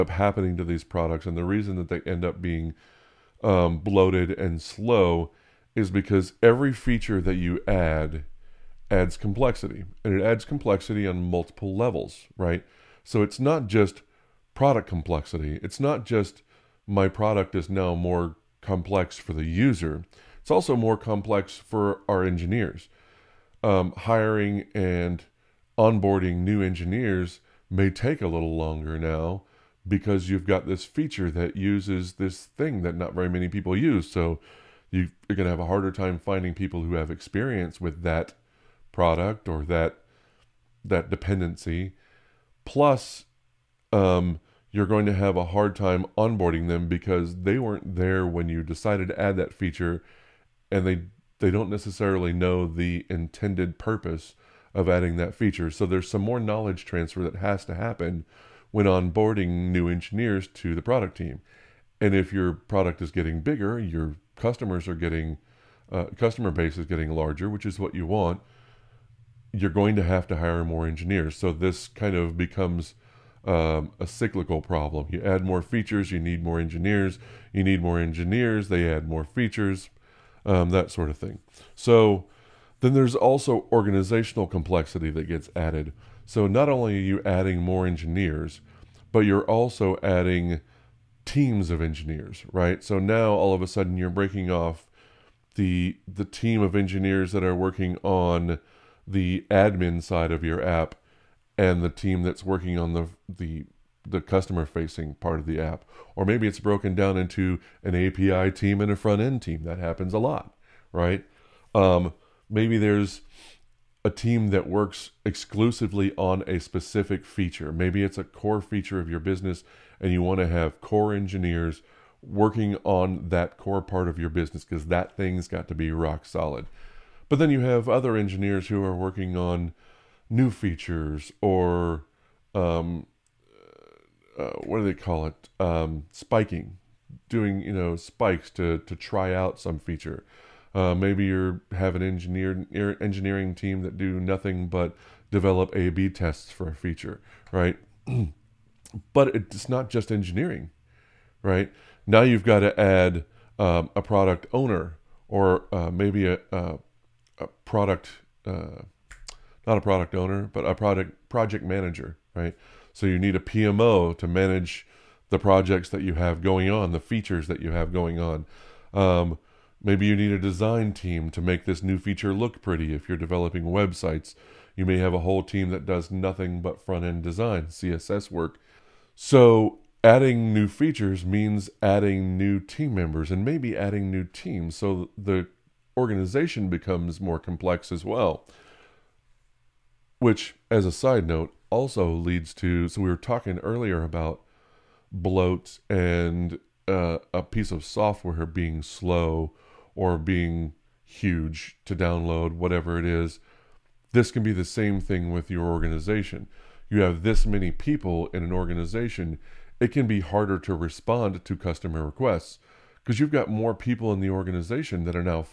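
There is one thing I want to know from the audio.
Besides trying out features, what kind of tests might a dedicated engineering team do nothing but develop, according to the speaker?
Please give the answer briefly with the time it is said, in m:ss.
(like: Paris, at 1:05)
A/B tests, at 2:25.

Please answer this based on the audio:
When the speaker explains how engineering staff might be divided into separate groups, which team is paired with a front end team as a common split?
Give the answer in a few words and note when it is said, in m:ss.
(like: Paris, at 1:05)
API team, at 1:47.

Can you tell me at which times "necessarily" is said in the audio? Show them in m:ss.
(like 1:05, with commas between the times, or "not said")
0:51.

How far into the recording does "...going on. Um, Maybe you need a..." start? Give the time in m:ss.
2:47.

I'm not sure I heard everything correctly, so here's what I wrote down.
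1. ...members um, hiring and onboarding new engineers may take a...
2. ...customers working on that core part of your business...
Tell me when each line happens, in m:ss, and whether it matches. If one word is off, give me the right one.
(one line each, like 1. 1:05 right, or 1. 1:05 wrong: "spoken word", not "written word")
1. 0:22 wrong: "engineers", not "members"
2. 2:01 wrong: "engineers", not "customers".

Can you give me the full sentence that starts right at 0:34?
So you're going to have a harder time finding people who have experience with that product or that that dependency.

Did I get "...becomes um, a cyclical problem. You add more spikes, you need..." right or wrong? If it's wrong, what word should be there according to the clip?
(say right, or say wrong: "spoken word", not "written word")
wrong: "features", not "spikes".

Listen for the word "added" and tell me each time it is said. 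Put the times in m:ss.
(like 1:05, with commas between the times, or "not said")
1:25.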